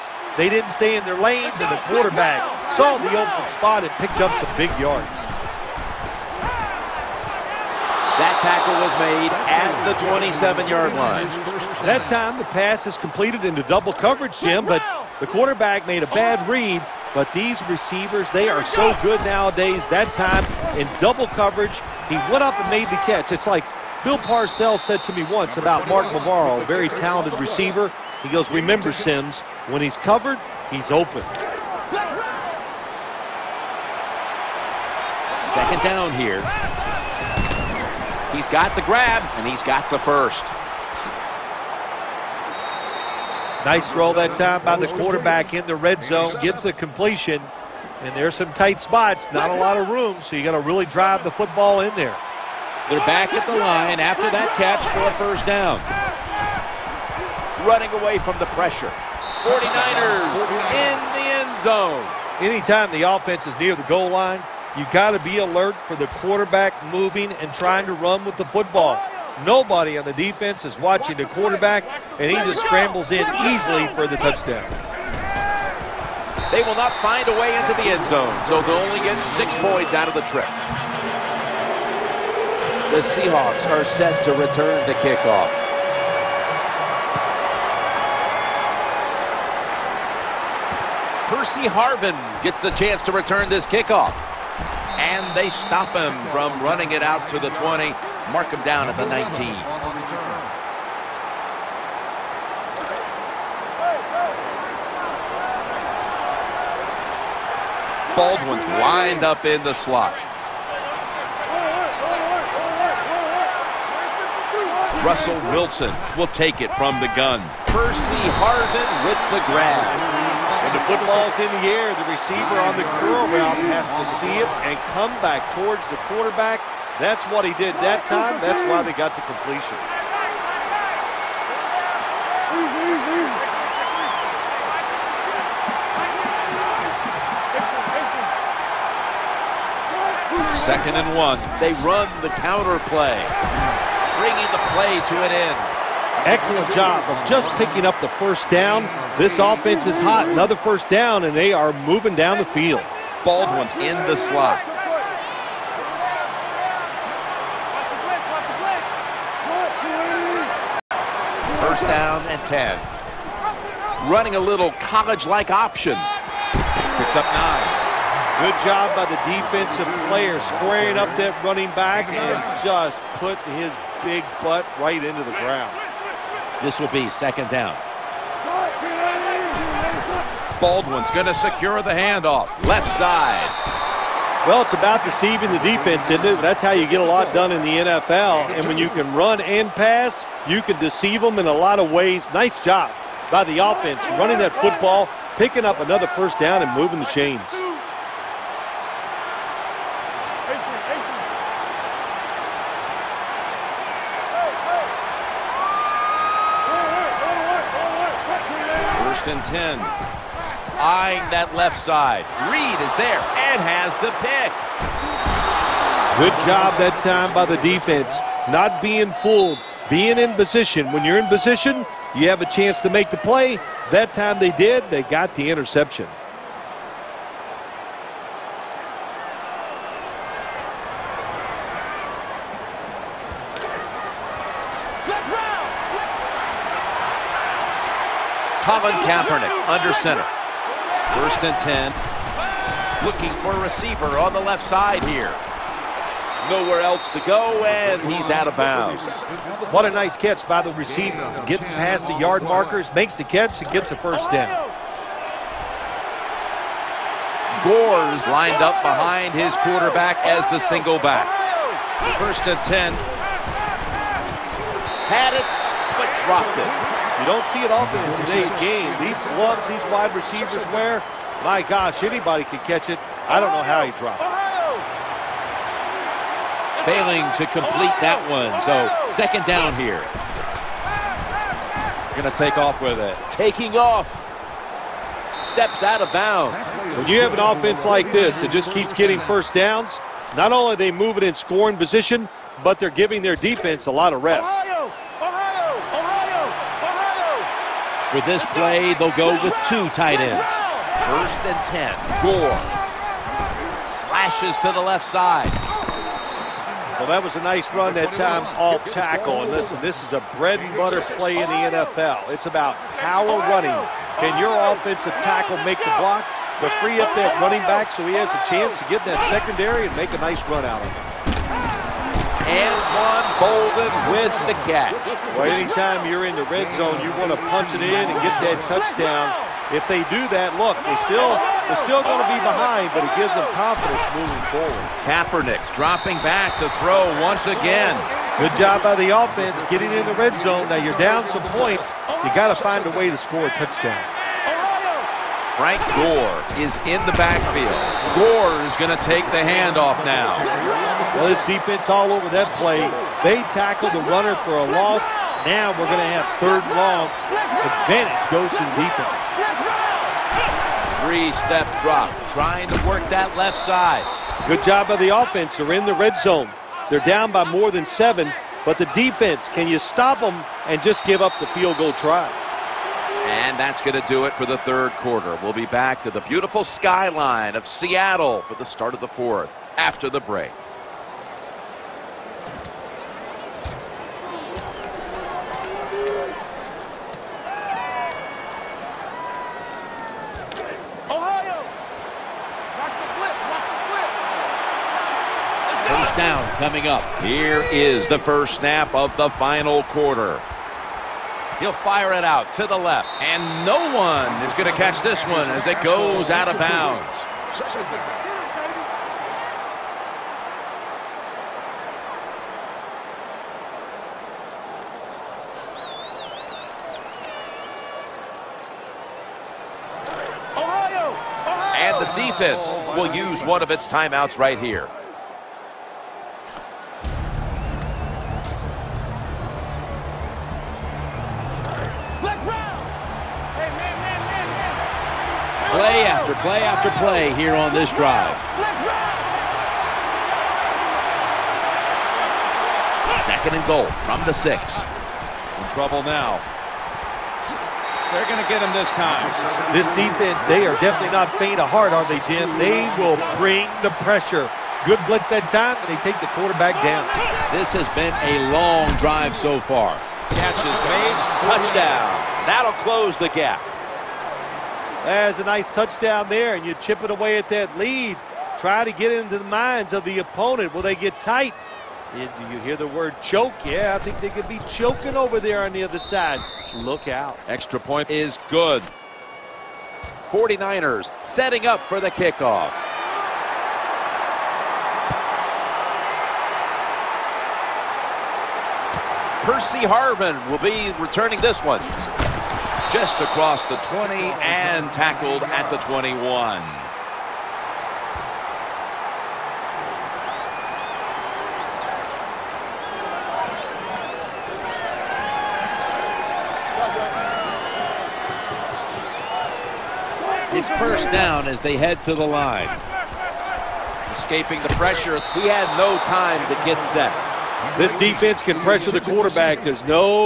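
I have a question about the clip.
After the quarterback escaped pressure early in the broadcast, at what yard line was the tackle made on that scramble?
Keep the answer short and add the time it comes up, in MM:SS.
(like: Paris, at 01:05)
27-yard line, at 00:10.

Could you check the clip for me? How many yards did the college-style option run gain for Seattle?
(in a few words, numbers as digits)
9.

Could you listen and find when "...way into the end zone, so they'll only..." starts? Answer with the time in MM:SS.
01:17.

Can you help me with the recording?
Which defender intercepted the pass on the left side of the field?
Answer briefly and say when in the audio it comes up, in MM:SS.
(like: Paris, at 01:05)
Reed, at 03:32.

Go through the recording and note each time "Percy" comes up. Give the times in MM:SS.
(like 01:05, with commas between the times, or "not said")
01:31, 01:57, 08:09.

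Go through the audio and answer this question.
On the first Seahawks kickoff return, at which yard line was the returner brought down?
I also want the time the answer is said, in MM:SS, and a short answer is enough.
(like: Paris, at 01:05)
19, at 01:39.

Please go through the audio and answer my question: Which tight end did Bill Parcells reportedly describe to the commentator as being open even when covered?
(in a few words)
Mark Bavaro.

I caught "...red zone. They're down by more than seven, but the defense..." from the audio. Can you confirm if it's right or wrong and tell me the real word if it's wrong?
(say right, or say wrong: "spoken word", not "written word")
right.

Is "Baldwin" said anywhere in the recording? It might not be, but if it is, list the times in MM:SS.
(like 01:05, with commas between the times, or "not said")
01:48, 02:33, 03:00.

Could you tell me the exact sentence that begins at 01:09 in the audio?
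Nobody on the defense is watching the quarterback, and he just scrambles in easily for the touchdown.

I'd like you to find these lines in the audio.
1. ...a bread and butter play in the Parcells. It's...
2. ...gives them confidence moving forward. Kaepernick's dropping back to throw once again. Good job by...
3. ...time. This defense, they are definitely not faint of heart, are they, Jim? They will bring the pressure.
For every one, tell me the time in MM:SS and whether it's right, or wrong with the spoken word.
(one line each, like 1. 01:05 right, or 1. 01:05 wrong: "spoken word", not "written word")
1. 05:10 wrong: "NFL", not "Parcells"
2. 05:33 right
3. 07:28 right.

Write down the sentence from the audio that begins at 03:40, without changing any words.
When you're in position, you have a chance to make the play.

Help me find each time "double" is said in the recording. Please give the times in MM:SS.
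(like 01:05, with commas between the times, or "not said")
00:13, 00:20.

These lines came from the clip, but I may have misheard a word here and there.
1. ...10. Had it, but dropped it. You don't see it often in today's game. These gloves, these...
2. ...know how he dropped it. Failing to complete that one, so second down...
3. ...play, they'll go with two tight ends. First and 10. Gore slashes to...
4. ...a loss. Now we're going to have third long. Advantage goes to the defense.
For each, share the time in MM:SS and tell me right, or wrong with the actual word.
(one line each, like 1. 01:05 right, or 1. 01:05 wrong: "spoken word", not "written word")
1. 04:22 right
2. 04:33 right
3. 04:58 right
4. 05:54 right.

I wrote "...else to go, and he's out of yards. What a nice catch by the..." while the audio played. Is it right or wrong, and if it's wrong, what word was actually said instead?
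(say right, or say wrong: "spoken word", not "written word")
wrong: "bounds", not "yards".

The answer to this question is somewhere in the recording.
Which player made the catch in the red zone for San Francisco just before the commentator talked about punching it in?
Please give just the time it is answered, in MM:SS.
05:23.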